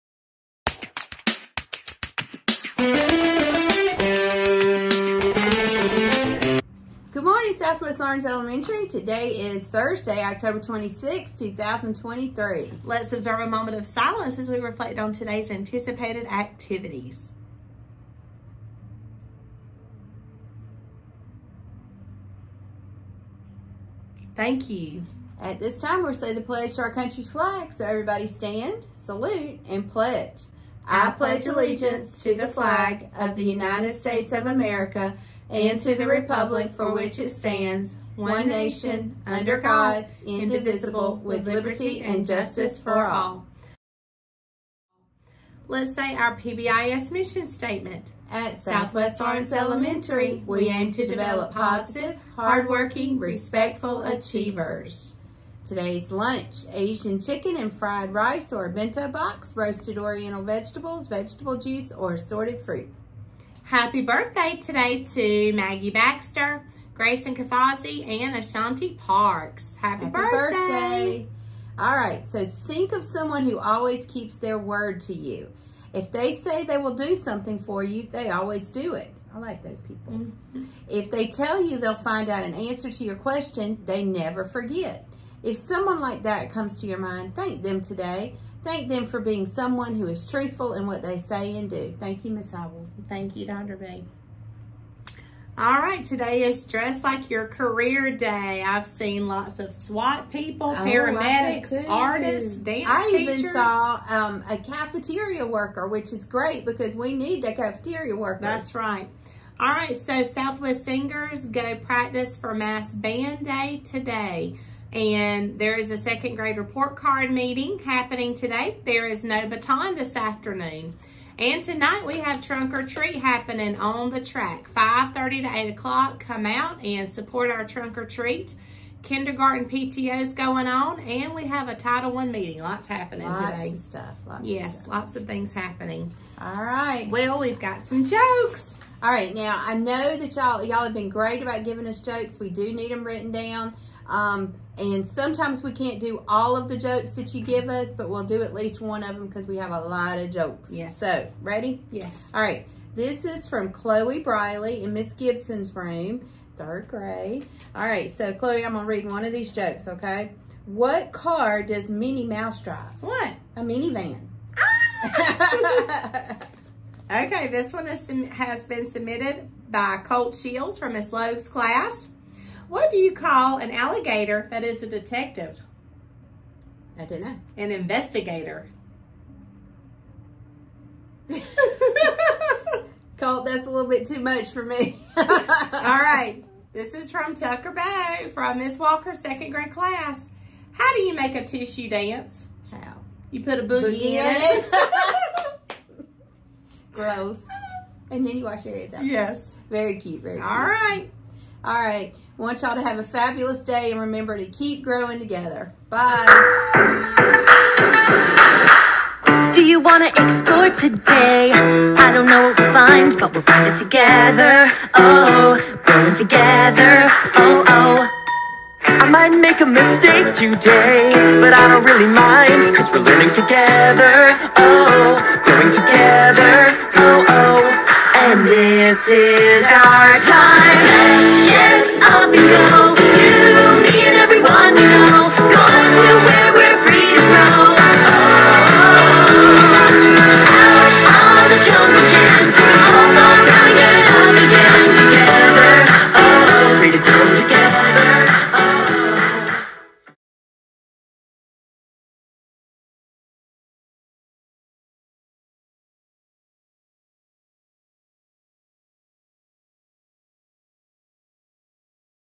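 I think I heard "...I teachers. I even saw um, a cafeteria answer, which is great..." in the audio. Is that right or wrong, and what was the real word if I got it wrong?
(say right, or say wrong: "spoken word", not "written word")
wrong: "worker", not "answer".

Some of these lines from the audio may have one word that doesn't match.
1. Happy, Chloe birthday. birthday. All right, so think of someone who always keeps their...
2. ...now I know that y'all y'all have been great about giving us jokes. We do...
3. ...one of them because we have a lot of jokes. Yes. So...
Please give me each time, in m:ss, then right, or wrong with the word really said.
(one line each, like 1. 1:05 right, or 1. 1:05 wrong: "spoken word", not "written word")
1. 1:09 wrong: "Happy", not "Chloe"
2. 2:19 right
3. 2:28 right.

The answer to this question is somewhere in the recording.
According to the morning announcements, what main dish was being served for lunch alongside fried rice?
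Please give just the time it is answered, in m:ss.
0:56.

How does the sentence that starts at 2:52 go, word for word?
What do you call an alligator that is a detective?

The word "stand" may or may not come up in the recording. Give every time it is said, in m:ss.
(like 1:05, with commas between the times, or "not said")
0:28, 0:37.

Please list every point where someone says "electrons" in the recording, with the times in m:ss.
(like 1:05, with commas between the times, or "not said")
not said.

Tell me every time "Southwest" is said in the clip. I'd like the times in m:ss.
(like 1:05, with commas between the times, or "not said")
0:07, 0:48, 1:50.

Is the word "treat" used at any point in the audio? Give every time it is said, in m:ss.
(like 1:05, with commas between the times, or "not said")
2:02, 2:08.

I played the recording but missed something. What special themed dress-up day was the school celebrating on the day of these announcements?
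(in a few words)
Dress Like Your Career Day.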